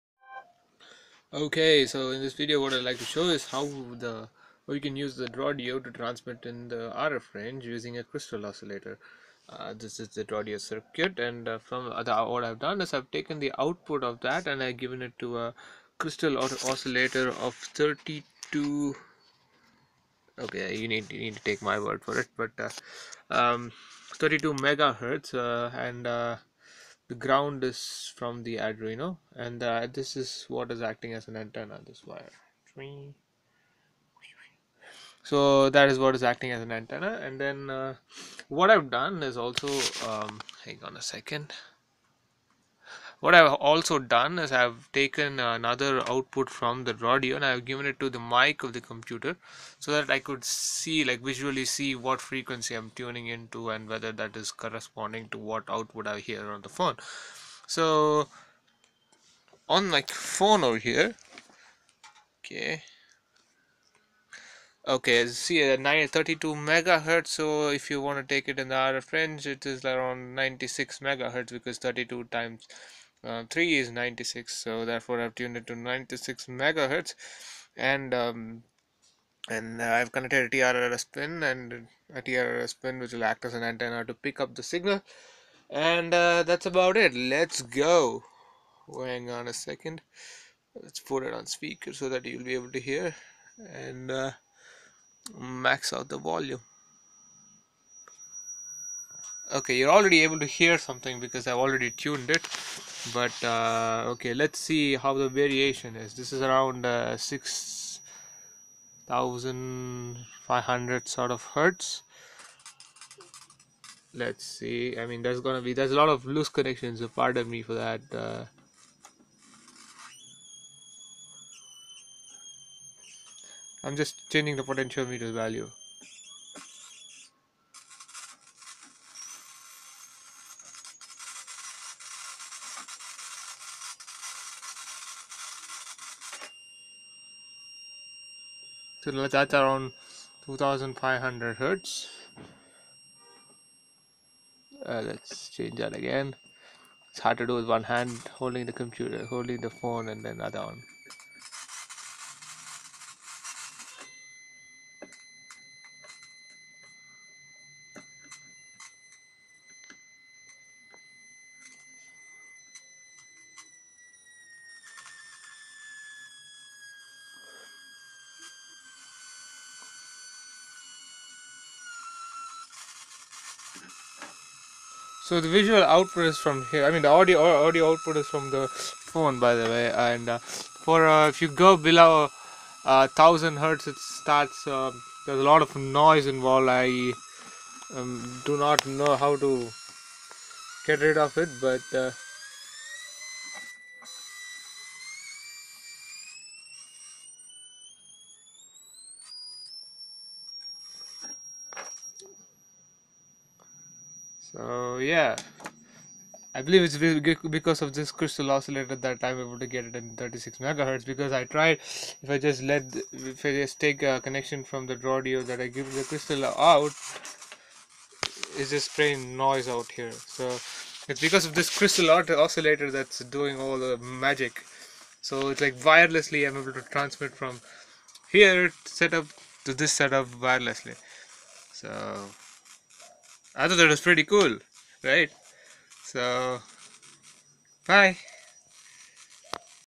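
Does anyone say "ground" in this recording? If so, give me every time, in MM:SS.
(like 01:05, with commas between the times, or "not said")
00:27.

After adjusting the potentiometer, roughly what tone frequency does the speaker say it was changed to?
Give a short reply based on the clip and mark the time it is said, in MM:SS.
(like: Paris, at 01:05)
2500 Hz, at 02:20.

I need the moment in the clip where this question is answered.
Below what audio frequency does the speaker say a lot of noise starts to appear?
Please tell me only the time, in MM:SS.
03:03.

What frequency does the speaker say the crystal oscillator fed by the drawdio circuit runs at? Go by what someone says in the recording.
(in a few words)
32 MHz.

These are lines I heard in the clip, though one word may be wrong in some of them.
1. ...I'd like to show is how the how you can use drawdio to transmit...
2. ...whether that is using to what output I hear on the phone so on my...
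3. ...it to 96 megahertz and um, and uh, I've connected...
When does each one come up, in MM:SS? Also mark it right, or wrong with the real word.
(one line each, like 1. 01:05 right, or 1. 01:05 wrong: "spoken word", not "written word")
1. 00:02 right
2. 00:53 wrong: "corresponding", not "using"
3. 01:15 right.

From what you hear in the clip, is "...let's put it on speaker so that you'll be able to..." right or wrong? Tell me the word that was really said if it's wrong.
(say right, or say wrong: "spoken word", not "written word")
right.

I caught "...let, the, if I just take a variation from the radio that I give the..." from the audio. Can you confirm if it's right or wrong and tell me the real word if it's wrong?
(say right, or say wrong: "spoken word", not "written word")
wrong: "connection", not "variation".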